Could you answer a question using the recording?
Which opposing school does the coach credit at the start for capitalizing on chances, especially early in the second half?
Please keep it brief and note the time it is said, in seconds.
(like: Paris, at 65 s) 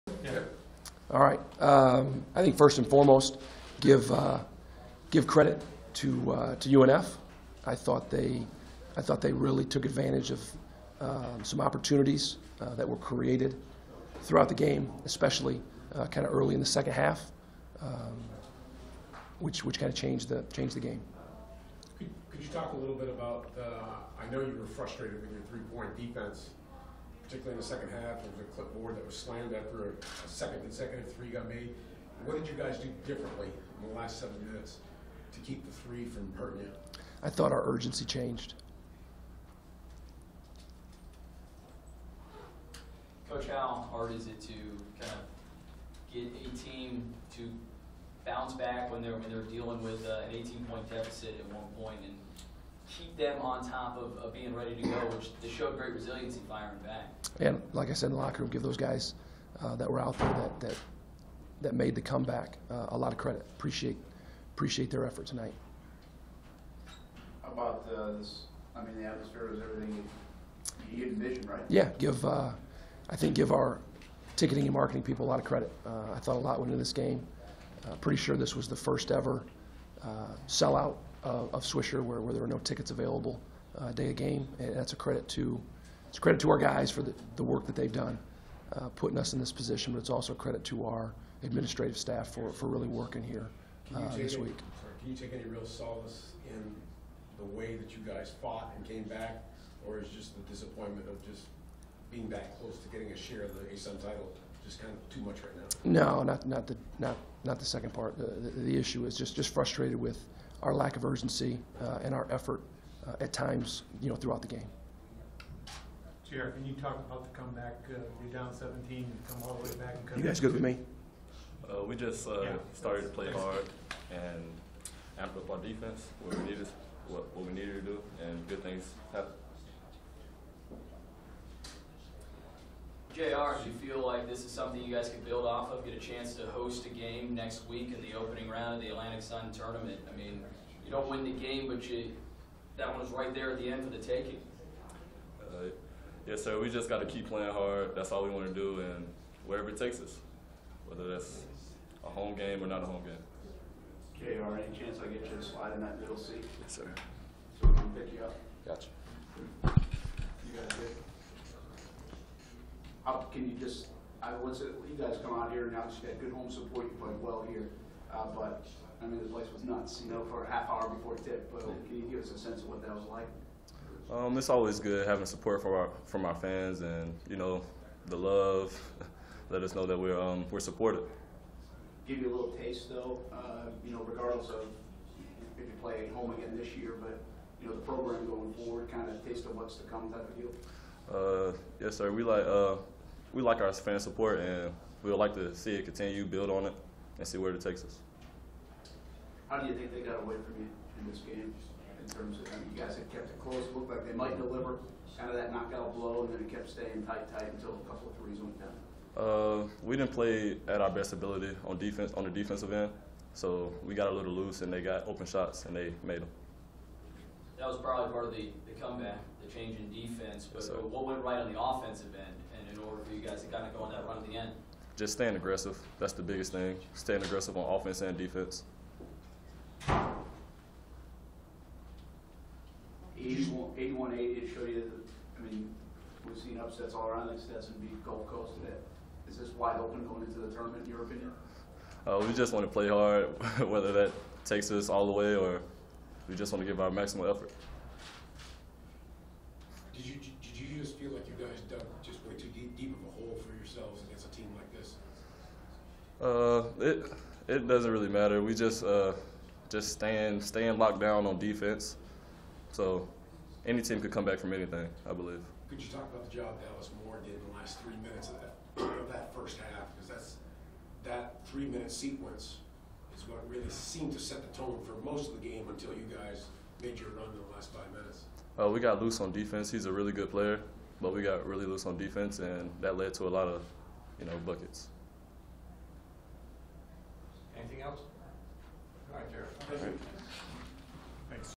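UNF, at 6 s.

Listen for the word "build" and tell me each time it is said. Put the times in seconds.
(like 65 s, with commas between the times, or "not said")
135 s, 196 s.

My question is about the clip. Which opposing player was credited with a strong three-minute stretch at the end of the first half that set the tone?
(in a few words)
Dallas Moore.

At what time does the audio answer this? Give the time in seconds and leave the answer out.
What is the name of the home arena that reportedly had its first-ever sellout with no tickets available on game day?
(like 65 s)
81 s.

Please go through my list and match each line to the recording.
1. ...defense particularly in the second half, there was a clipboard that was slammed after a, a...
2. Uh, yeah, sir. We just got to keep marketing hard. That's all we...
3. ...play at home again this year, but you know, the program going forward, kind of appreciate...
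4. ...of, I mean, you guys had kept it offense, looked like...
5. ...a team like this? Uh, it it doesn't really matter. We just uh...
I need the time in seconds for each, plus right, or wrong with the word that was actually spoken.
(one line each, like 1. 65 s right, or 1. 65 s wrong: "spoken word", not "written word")
1. 25 s right
2. 145 s wrong: "playing", not "marketing"
3. 185 s wrong: "taste", not "appreciate"
4. 202 s wrong: "close", not "offense"
5. 254 s right.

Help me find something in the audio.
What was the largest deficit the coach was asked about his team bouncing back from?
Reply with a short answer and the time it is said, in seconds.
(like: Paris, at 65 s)
18 points, at 50 s.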